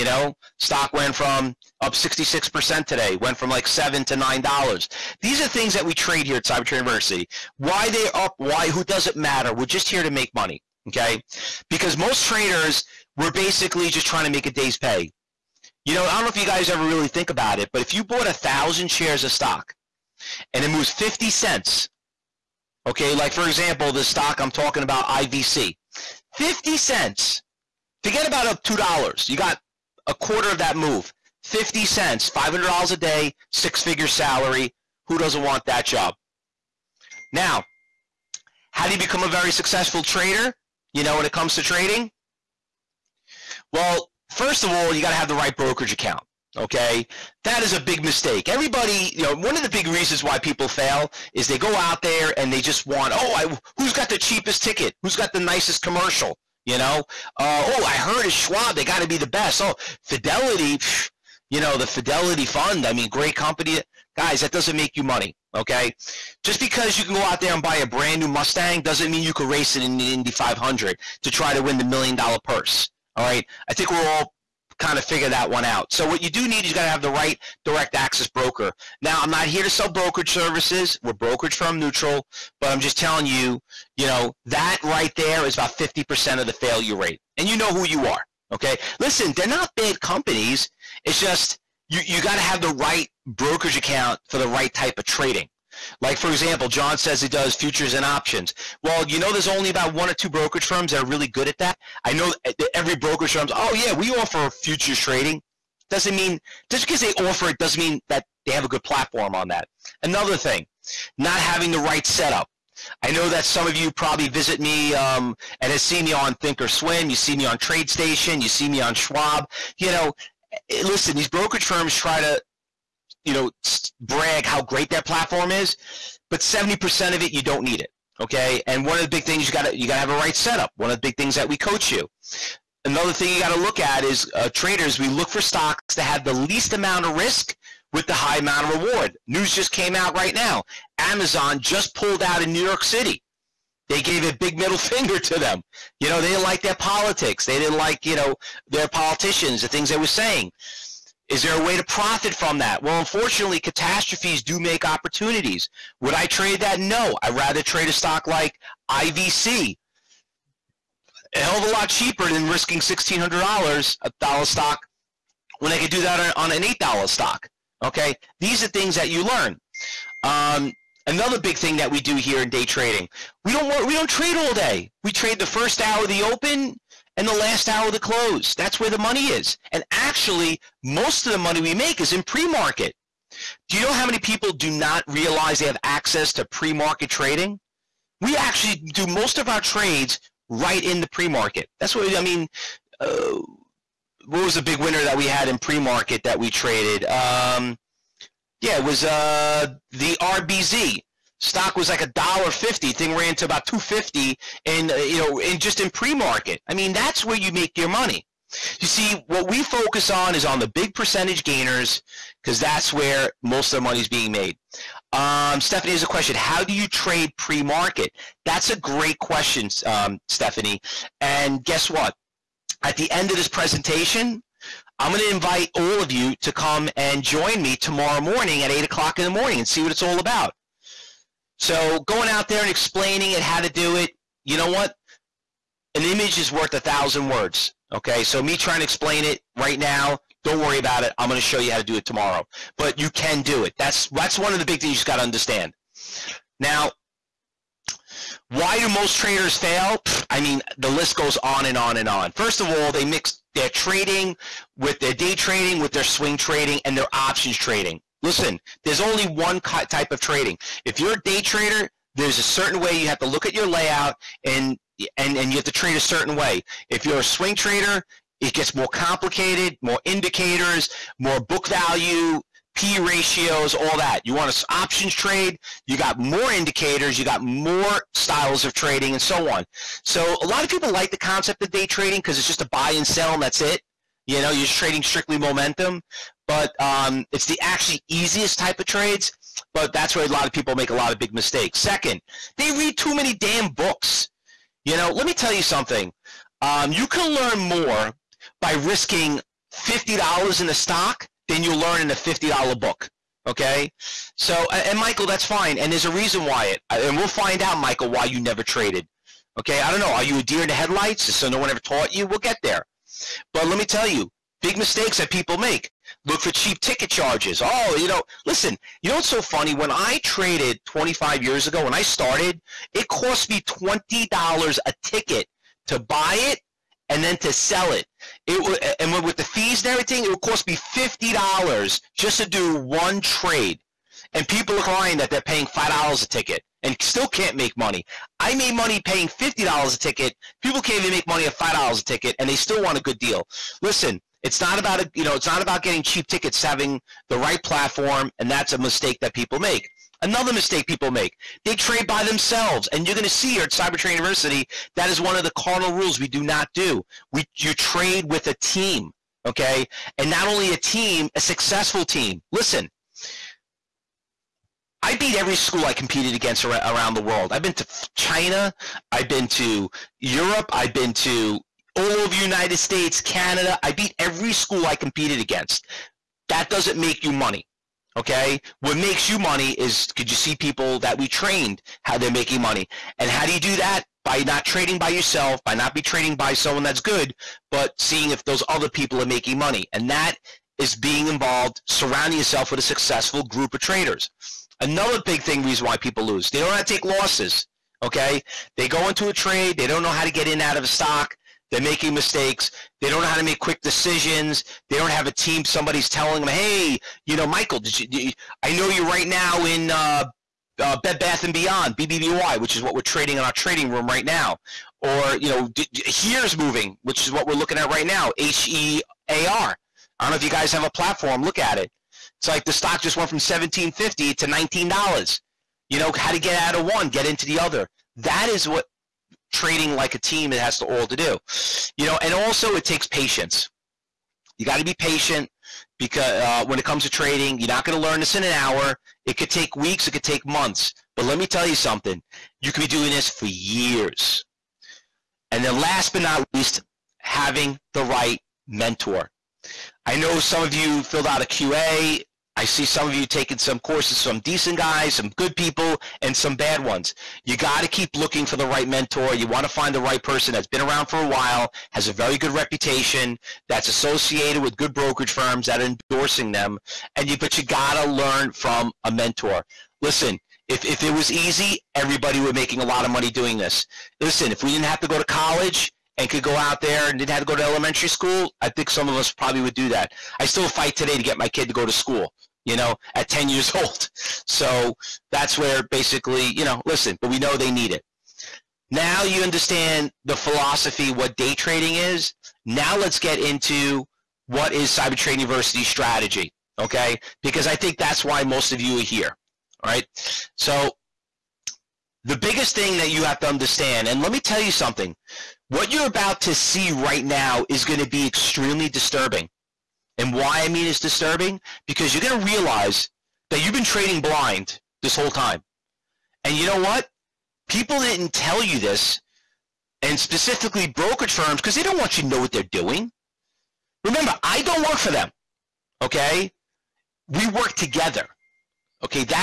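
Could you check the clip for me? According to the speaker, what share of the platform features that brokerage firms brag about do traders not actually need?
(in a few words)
70%.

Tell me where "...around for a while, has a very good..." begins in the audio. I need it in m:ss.
7:40.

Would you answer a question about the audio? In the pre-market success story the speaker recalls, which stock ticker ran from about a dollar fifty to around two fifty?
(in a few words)
RBZ.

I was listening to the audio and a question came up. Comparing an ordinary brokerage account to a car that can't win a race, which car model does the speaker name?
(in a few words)
Mustang.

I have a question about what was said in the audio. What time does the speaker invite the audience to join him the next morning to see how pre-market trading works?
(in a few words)
8 o'clock.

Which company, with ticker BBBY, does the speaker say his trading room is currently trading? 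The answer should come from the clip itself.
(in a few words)
Bed Bath and Beyond.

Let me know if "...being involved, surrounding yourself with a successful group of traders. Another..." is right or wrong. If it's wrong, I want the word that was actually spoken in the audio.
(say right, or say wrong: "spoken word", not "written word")
right.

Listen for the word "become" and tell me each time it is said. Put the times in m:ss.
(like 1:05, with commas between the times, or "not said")
0:38.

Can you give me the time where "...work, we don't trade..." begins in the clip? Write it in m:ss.
2:53.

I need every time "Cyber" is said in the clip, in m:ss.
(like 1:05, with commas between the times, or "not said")
0:06, 5:53, 8:14.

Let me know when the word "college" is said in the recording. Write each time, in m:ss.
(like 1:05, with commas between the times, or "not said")
7:55.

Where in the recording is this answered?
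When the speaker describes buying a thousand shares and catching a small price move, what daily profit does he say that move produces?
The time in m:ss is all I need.
0:32.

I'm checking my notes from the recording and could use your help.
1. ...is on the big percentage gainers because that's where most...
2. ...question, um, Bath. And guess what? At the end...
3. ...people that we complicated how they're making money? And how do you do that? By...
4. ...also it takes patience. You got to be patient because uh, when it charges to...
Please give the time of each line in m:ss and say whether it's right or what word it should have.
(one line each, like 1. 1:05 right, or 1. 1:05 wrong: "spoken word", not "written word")
1. 3:30 right
2. 3:39 wrong: "Stephanie", not "Bath"
3. 6:20 wrong: "trained", not "complicated"
4. 7:12 wrong: "comes", not "charges".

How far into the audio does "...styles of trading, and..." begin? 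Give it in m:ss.
4:38.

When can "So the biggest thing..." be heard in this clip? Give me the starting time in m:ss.
8:20.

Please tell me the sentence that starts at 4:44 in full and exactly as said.
You know, you're just trading strictly momentum but um, it's the actually easiest type of trades.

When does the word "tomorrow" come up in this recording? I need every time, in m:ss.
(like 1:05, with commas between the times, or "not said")
3:47, 4:02.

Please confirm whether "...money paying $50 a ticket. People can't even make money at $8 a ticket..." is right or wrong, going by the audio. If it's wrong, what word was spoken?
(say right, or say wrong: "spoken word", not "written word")
wrong: "5", not "8".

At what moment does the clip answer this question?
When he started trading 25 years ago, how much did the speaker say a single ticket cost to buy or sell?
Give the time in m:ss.
5:23.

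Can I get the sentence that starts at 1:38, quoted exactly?
Well, you know, there's only about one or two brokerage firms that are really good at that.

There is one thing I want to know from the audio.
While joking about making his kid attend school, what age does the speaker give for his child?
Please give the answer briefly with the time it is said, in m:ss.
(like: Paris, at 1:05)
10, at 8:03.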